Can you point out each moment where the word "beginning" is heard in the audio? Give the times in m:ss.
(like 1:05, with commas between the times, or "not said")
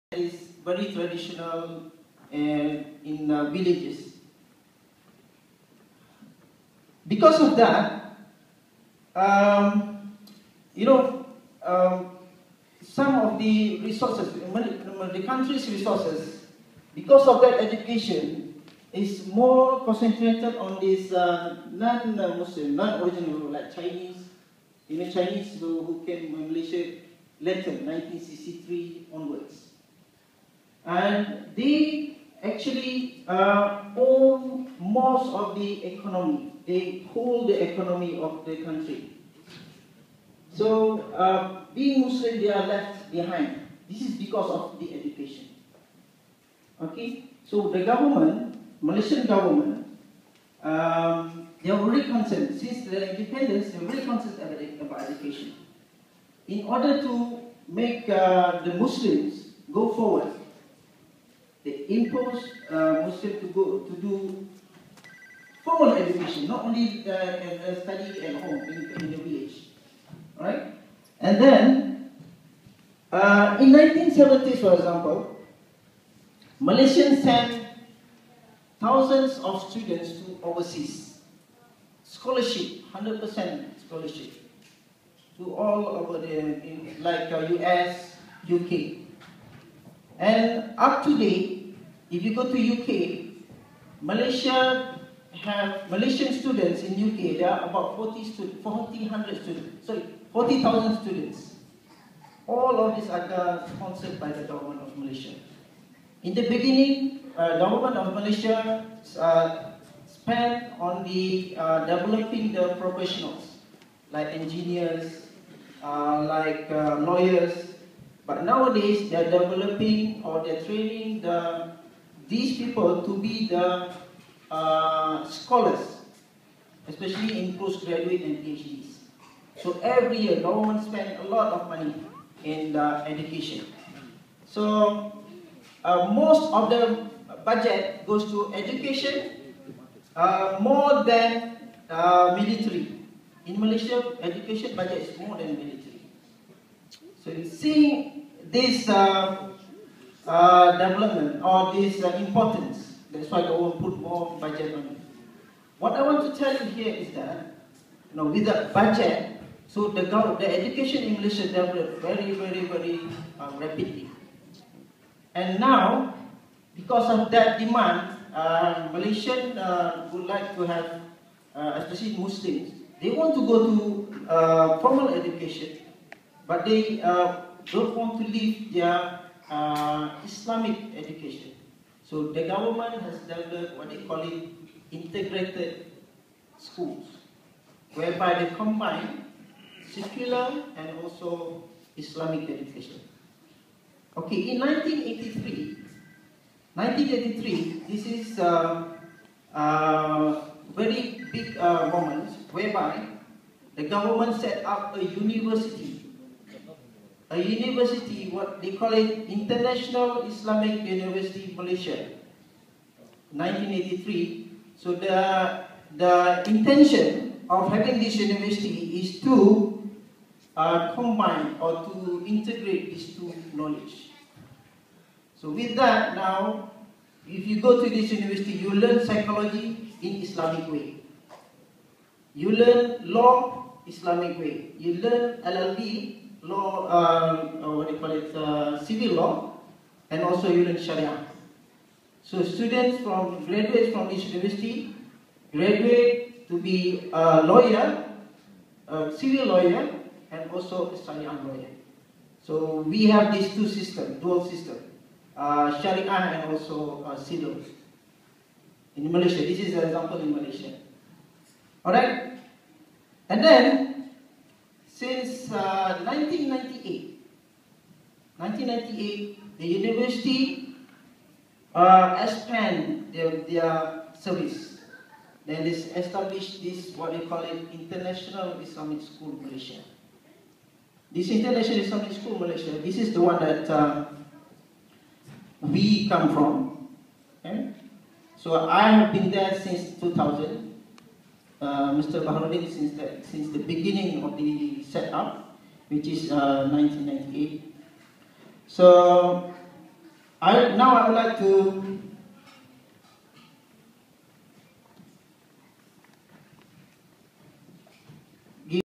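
1:46, 4:53.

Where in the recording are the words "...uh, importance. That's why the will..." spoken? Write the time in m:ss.
2:32.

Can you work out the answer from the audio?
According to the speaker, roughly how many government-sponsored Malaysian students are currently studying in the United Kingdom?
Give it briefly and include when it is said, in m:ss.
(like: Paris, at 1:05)
40,000, at 1:40.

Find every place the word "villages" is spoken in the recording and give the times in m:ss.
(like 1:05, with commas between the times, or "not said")
0:03, 1:09.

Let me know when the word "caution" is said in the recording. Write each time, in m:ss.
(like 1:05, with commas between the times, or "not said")
not said.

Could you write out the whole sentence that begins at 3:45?
So with that now, if you go to this university, you learn psychology in Islamic way.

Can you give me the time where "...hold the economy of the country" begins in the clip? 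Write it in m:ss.
0:37.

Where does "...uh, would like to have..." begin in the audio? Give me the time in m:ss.
2:49.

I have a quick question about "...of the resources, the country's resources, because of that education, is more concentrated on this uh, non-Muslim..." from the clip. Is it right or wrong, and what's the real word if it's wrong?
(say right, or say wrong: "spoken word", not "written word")
right.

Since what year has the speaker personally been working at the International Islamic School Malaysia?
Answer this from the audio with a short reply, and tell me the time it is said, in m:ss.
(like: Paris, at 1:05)
2000, at 4:49.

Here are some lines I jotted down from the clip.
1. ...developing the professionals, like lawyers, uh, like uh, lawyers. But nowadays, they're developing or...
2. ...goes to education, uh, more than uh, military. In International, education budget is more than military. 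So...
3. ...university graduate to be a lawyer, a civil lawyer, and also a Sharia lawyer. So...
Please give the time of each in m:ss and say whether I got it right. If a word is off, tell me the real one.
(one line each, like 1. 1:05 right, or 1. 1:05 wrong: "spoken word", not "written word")
1. 1:51 wrong: "engineers", not "lawyers"
2. 2:18 wrong: "Malaysia", not "International"
3. 4:04 right.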